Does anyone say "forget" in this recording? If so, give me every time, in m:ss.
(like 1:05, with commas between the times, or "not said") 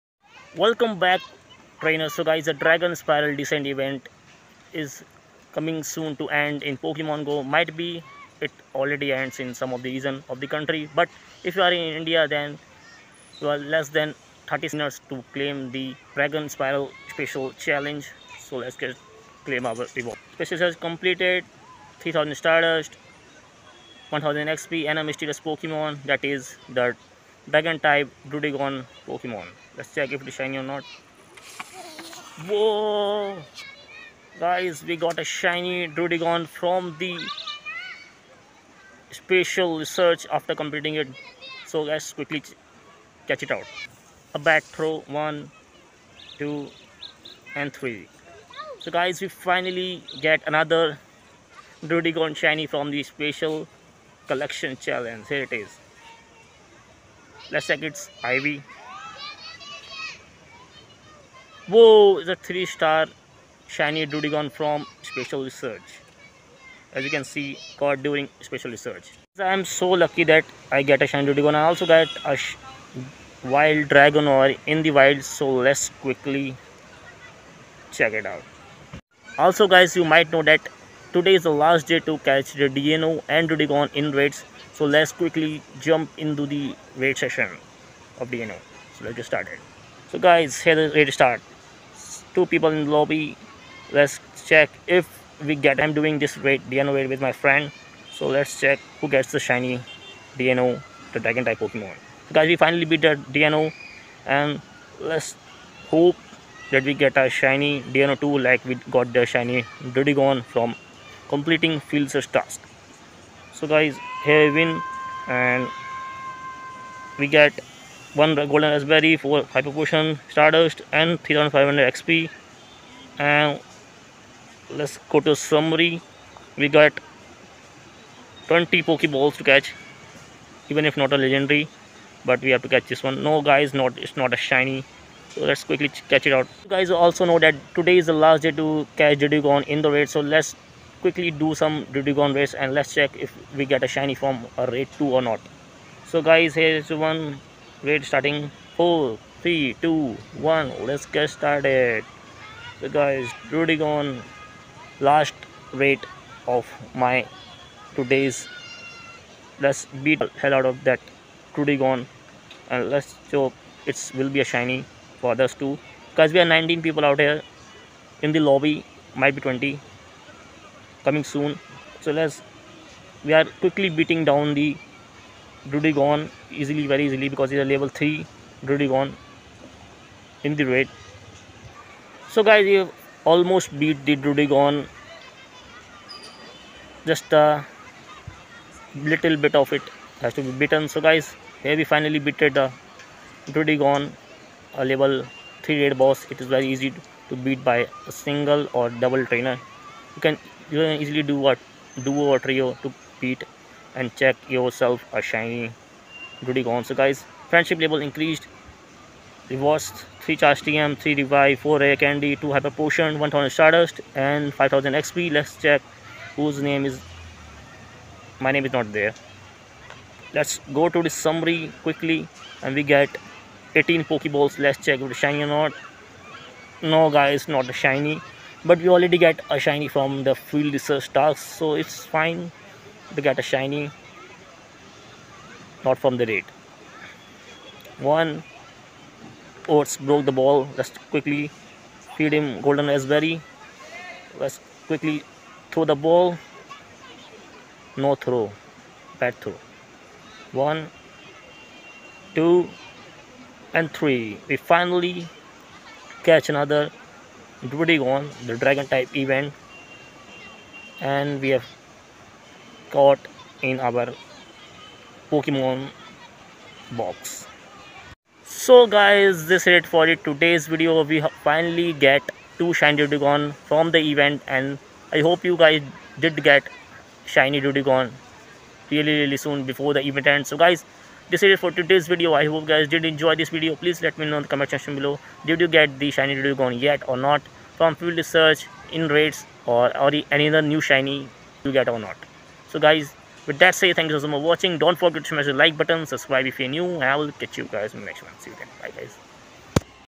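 4:55.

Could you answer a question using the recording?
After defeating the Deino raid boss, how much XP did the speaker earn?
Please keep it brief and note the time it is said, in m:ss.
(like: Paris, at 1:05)
3500, at 2:01.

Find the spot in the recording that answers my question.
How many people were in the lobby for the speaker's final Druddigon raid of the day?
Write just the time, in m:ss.
2:46.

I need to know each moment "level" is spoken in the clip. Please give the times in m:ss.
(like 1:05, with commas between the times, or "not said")
2:57, 3:14, 3:27.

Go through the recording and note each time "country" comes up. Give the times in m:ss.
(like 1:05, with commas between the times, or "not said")
0:10.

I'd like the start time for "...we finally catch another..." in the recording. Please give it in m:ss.
4:14.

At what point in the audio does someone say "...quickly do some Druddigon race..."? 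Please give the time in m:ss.
2:21.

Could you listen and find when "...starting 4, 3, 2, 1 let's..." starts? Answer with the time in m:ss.
2:28.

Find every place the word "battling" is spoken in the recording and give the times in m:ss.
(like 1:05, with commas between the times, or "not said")
not said.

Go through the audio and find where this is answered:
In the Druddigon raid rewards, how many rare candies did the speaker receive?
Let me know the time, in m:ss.
3:31.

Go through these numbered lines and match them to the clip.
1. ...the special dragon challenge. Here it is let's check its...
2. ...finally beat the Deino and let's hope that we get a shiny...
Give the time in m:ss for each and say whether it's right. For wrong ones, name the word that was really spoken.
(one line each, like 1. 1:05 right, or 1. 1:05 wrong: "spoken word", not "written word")
1. 0:52 wrong: "collection", not "dragon"
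2. 1:42 right.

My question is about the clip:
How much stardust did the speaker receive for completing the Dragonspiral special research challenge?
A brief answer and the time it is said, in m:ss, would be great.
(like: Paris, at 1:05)
3000, at 0:22.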